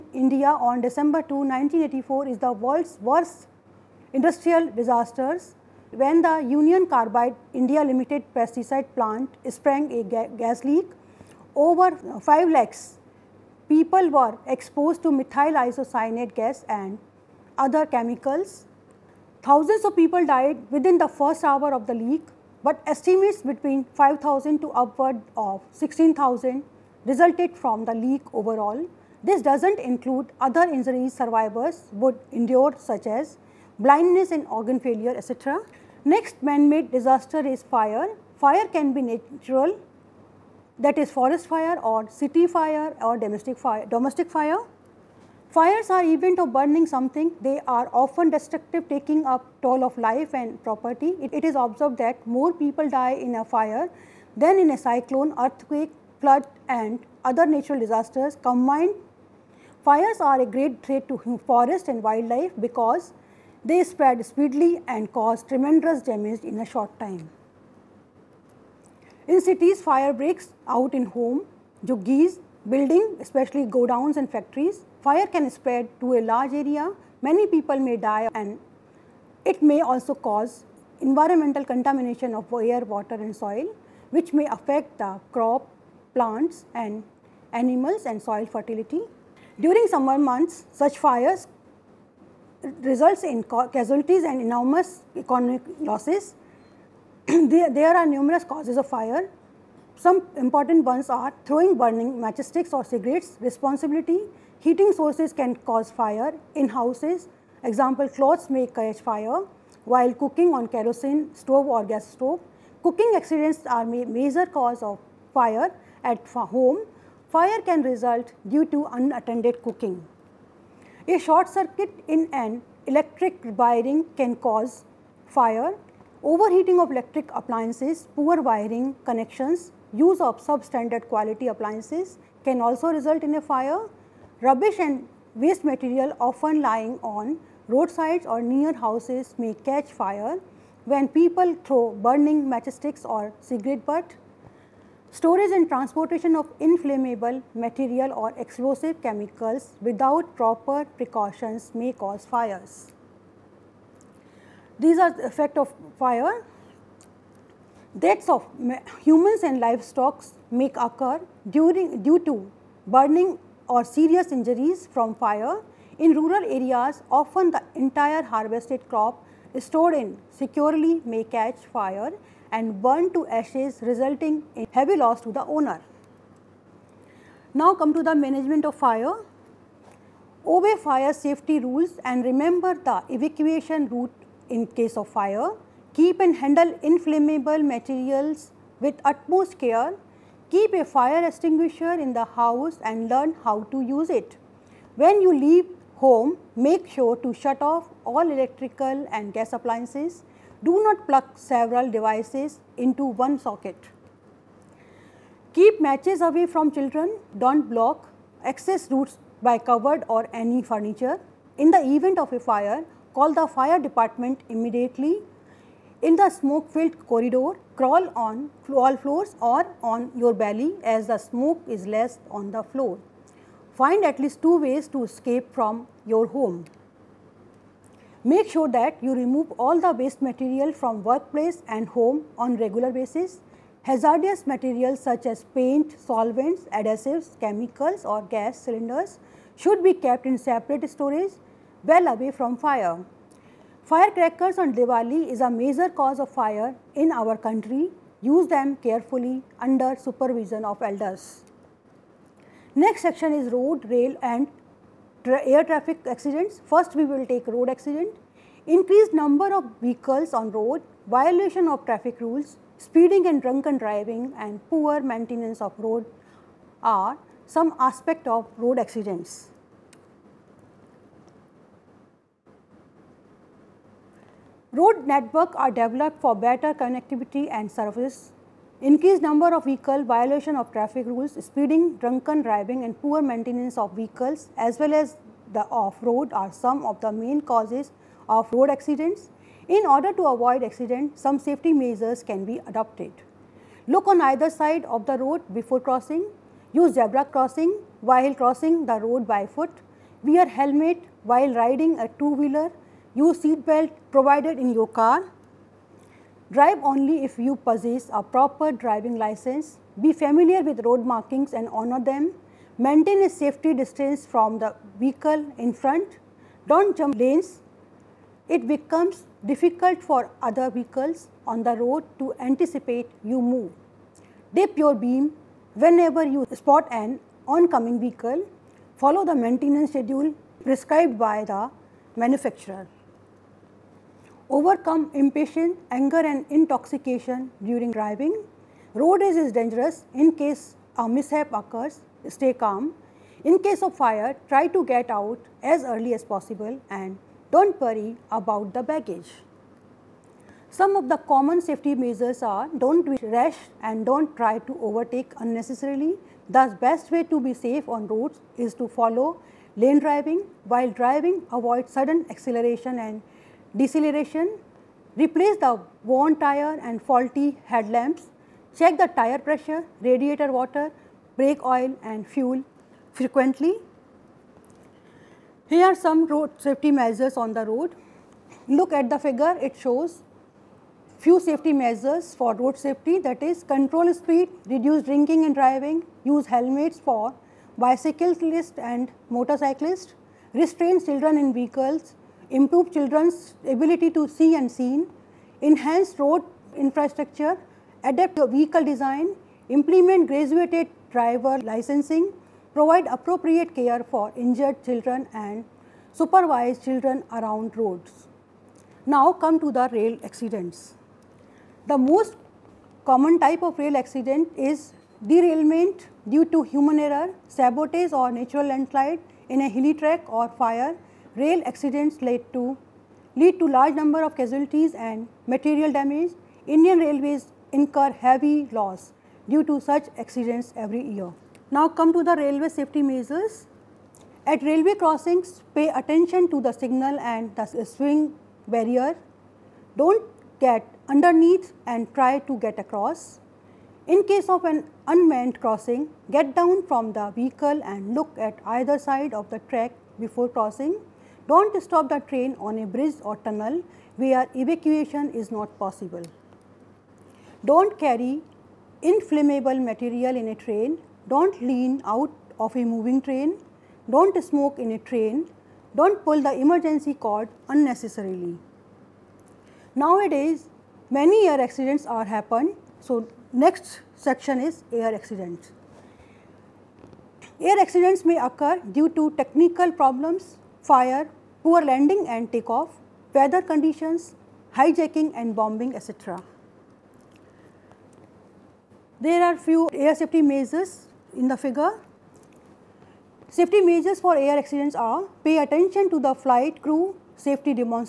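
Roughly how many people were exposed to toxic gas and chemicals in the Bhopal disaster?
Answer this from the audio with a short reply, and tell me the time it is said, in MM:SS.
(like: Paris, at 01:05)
5 lakh, at 00:12.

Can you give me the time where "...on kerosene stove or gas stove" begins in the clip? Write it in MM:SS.
01:50.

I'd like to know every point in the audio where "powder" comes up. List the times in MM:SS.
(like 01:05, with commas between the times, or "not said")
not said.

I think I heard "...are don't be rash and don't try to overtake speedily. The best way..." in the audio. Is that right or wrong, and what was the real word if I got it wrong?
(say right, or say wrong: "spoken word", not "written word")
wrong: "unnecessarily", not "speedily".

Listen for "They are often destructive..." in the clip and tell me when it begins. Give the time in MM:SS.
00:47.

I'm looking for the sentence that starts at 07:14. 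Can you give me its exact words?
At railway crossings, pay attention to the signal and the swing barrier.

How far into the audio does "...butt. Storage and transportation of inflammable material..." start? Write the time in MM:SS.
02:23.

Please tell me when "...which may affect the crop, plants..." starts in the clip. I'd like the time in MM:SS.
01:24.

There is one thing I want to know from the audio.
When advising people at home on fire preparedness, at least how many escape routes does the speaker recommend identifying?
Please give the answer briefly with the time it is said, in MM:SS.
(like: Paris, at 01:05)
2, at 03:44.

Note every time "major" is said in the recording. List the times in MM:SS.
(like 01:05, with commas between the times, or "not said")
01:54, 04:05.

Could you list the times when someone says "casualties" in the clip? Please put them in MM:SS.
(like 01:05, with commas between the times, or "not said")
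01:33, 07:04.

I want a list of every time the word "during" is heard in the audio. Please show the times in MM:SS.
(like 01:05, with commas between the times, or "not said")
01:29, 02:41, 05:37.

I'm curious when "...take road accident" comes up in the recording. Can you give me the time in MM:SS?
04:17.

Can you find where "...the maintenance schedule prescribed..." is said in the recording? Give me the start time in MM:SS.
05:29.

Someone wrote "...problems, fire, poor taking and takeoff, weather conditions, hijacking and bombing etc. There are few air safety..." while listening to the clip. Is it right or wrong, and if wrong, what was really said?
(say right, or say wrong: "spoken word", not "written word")
wrong: "landing", not "taking".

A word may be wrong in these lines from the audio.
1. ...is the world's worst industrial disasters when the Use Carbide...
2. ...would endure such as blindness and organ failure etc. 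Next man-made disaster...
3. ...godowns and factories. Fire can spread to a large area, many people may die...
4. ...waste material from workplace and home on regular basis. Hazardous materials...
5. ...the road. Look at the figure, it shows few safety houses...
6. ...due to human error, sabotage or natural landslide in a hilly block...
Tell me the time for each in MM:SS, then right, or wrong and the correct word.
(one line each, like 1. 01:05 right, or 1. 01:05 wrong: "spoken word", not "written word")
1. 00:02 wrong: "Union", not "Use"
2. 00:31 right
3. 01:13 right
4. 03:49 right
5. 06:17 wrong: "measures", not "houses"
6. 06:56 wrong: "track", not "block".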